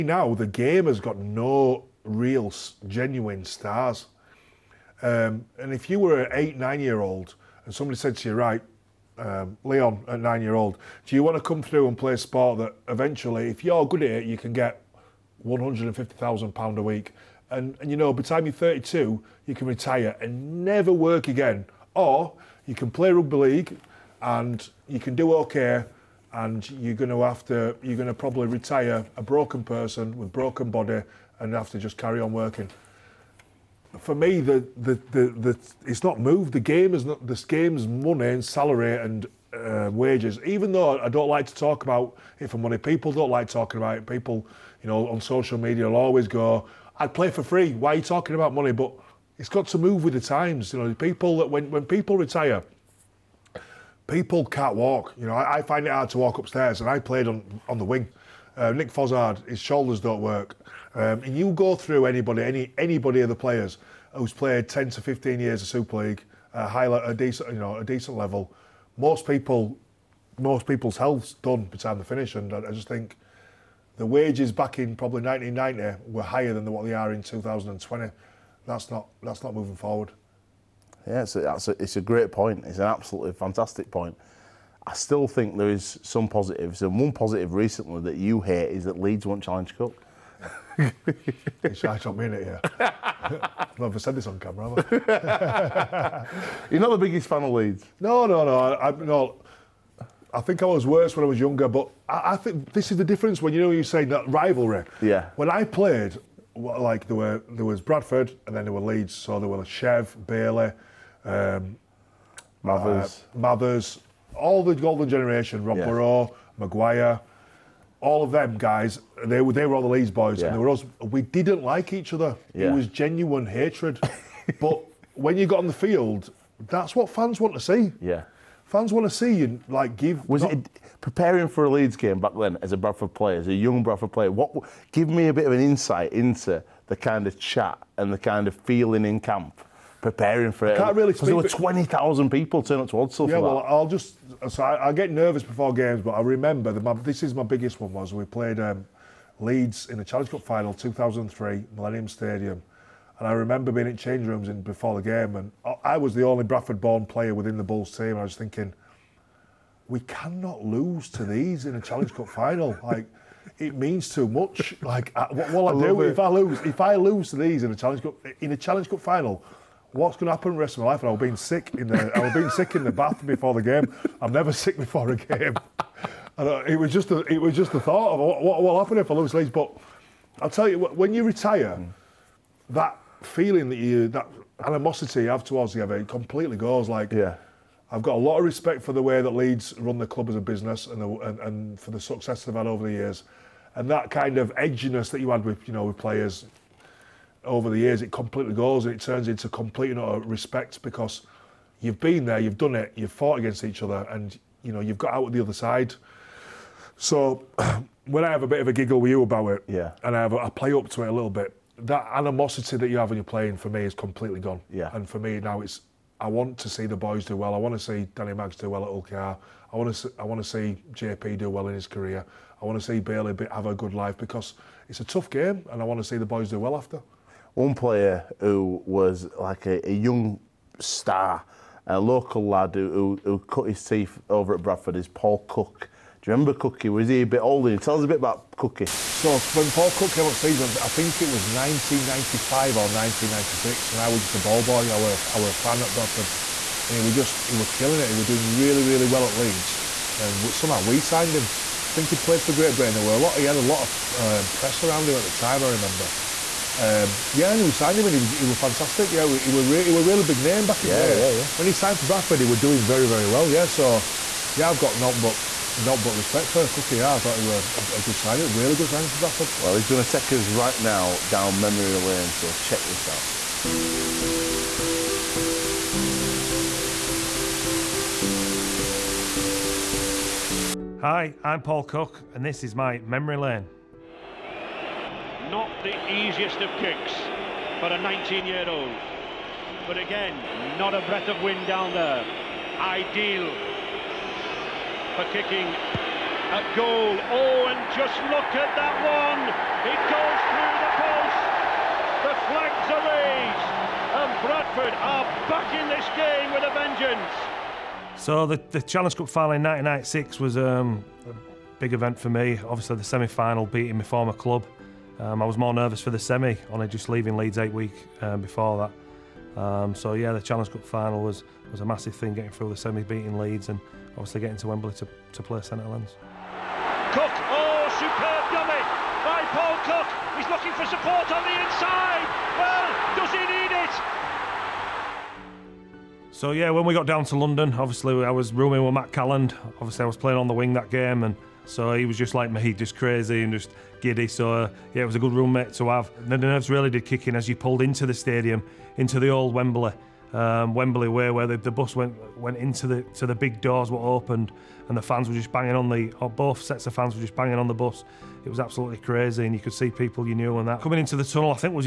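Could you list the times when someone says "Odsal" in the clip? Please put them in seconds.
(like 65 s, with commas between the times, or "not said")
142 s.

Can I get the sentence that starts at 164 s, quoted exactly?
Like, what will I, I do if I lose?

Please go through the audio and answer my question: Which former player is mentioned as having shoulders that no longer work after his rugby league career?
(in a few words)
Nick Fozzard.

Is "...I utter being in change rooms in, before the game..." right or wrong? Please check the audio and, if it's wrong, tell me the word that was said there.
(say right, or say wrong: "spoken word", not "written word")
wrong: "remember", not "utter".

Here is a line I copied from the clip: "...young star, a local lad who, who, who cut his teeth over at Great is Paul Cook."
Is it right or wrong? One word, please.
wrong.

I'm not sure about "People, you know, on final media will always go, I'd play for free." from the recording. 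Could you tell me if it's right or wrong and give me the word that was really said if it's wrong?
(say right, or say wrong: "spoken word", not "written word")
wrong: "social", not "final".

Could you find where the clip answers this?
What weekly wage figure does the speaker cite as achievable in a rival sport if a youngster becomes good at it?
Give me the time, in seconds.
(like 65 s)
15 s.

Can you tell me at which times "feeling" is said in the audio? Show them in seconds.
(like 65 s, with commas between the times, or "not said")
138 s, 183 s.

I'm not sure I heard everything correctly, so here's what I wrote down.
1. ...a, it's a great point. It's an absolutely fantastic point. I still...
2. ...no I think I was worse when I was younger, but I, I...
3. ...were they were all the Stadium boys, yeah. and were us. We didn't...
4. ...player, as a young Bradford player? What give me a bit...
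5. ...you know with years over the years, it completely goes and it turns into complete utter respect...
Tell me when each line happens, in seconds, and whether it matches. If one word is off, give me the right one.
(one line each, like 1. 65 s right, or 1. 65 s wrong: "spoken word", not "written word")
1. 81 s right
2. 98 s right
3. 119 s wrong: "Leeds", not "Stadium"
4. 133 s right
5. 195 s wrong: "players", not "years".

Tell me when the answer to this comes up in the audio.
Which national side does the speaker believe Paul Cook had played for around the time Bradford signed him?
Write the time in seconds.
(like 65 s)
252 s.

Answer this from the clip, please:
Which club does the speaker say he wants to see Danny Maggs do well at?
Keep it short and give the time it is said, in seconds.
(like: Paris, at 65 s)
Hull KR, at 218 s.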